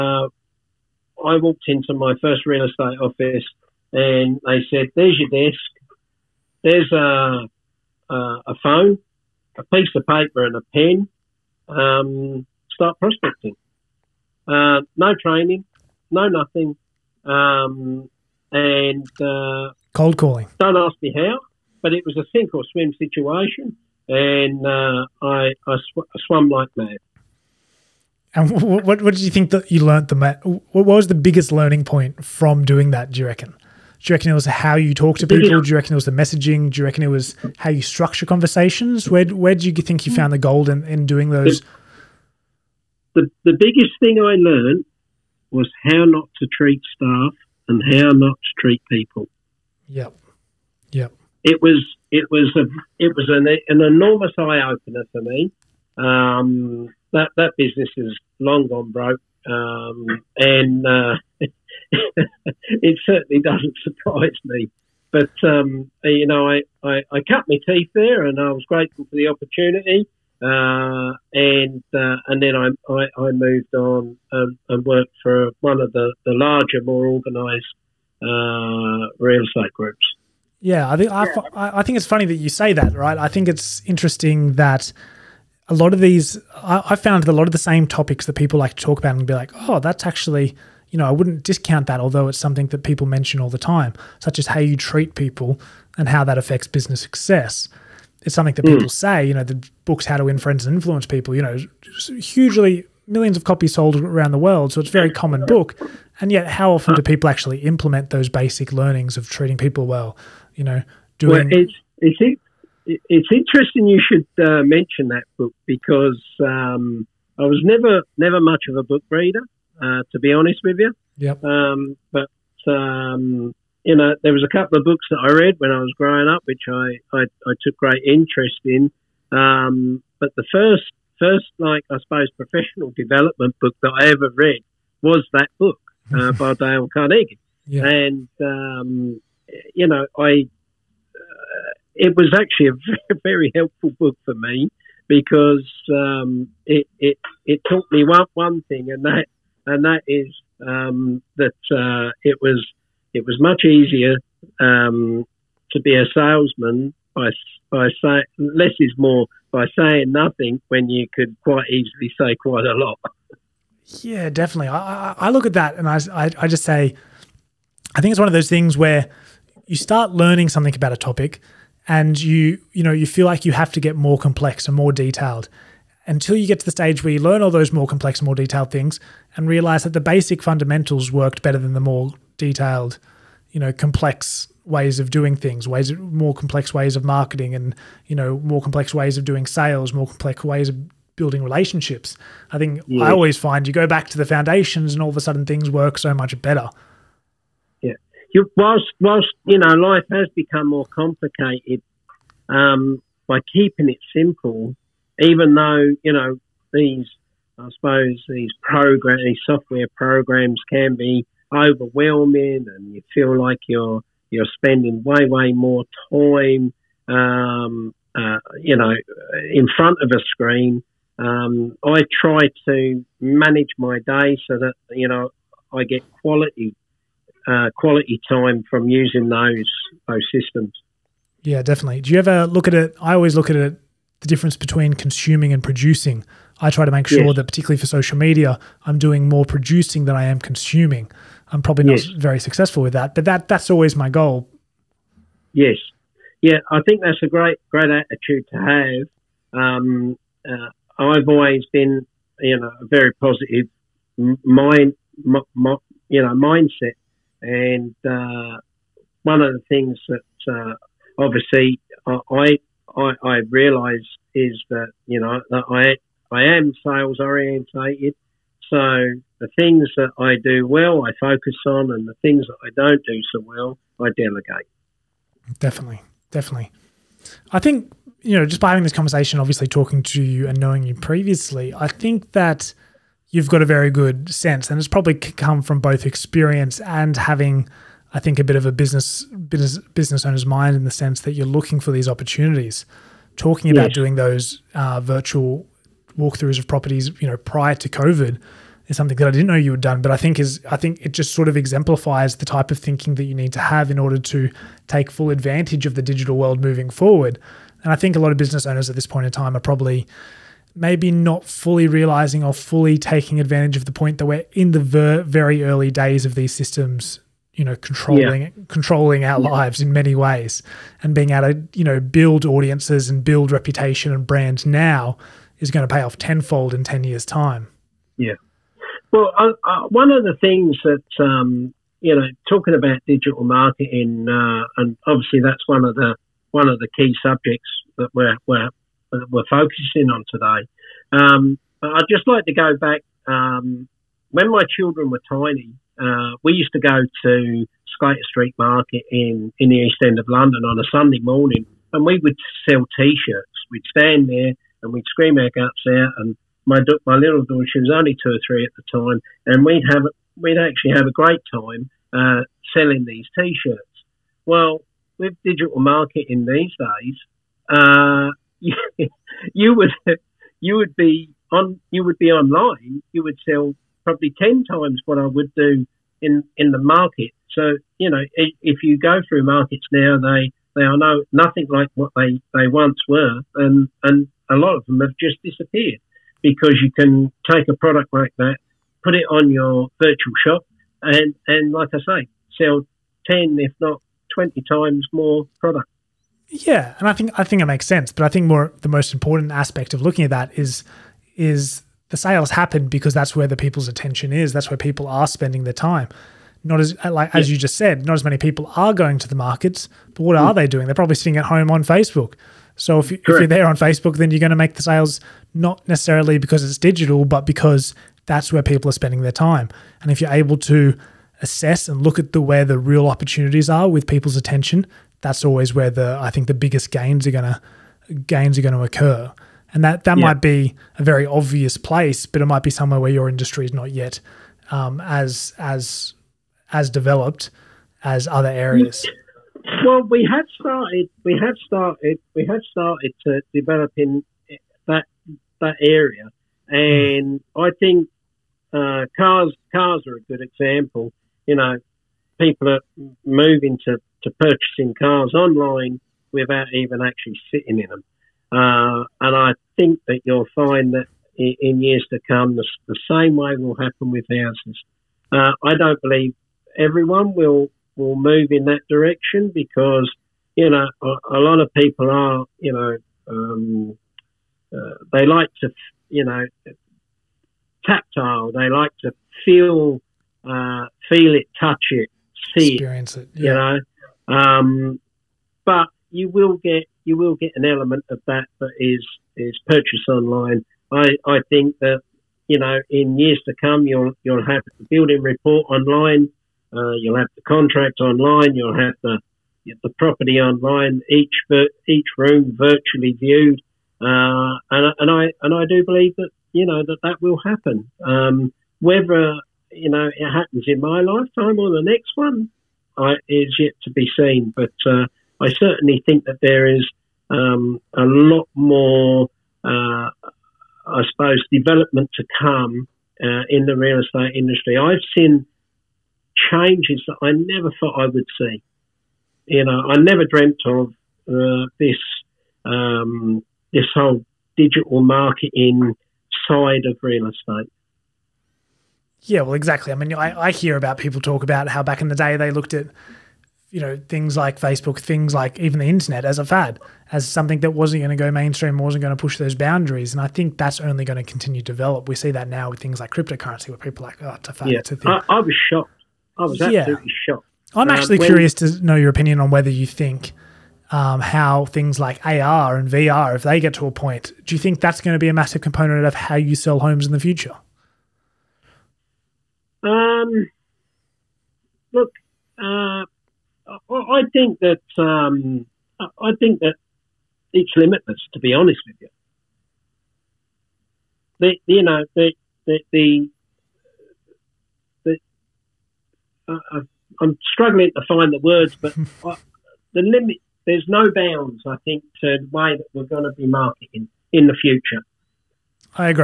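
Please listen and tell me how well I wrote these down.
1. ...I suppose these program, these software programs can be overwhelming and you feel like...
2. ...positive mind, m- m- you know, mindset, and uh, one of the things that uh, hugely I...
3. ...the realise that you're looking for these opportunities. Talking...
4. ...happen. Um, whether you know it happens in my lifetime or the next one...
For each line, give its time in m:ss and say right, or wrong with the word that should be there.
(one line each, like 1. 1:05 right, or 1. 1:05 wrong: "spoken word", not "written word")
1. 3:27 right
2. 4:13 wrong: "obviously", not "hugely"
3. 4:50 wrong: "sense", not "realise"
4. 8:27 right.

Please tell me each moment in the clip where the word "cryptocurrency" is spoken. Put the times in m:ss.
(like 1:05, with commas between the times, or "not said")
9:13.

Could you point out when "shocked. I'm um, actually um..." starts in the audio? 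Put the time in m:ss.
9:17.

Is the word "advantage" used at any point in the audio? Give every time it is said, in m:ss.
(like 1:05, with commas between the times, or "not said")
5:05, 5:13.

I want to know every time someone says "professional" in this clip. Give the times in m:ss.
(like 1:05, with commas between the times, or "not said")
2:12.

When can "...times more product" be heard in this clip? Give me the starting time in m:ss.
6:34.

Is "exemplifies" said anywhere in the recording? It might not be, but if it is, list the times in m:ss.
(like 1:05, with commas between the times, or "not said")
5:01.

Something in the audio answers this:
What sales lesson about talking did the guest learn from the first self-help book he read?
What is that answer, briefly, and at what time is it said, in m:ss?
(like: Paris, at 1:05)
Less is more, at 2:38.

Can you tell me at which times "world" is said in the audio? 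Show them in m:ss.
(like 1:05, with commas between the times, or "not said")
1:44, 5:06.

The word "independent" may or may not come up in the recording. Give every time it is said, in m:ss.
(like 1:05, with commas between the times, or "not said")
not said.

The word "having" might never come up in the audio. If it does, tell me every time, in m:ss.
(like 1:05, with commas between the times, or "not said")
4:38, 4:47.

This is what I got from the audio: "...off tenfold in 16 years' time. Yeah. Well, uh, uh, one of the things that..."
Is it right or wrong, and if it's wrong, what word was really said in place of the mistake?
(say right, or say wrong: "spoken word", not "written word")
wrong: "10", not "16".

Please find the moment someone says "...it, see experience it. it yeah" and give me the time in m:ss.
8:01.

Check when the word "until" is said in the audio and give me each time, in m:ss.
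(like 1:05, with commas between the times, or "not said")
2:56.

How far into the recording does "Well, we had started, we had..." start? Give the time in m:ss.
7:19.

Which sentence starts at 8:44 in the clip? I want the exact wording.
I've seen changes that I never thought I would see.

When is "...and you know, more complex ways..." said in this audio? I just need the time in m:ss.
3:07.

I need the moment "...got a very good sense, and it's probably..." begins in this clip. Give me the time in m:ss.
4:43.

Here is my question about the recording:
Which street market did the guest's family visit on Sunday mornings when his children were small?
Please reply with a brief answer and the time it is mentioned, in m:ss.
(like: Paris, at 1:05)
Sclater Street Market, at 5:47.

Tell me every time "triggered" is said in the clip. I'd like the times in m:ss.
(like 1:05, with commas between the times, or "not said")
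not said.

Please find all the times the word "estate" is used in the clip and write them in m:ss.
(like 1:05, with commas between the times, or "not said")
0:02, 1:19, 8:43, 8:57.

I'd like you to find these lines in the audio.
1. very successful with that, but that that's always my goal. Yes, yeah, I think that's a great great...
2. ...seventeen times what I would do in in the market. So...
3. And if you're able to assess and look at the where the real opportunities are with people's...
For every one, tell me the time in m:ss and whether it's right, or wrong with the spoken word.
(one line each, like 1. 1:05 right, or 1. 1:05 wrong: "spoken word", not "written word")
1. 4:02 right
2. 6:14 wrong: "ten", not "seventeen"
3. 7:00 right.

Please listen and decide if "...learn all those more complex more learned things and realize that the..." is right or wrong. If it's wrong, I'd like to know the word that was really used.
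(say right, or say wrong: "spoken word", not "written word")
wrong: "detailed", not "learned".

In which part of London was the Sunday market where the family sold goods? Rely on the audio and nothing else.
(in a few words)
East End.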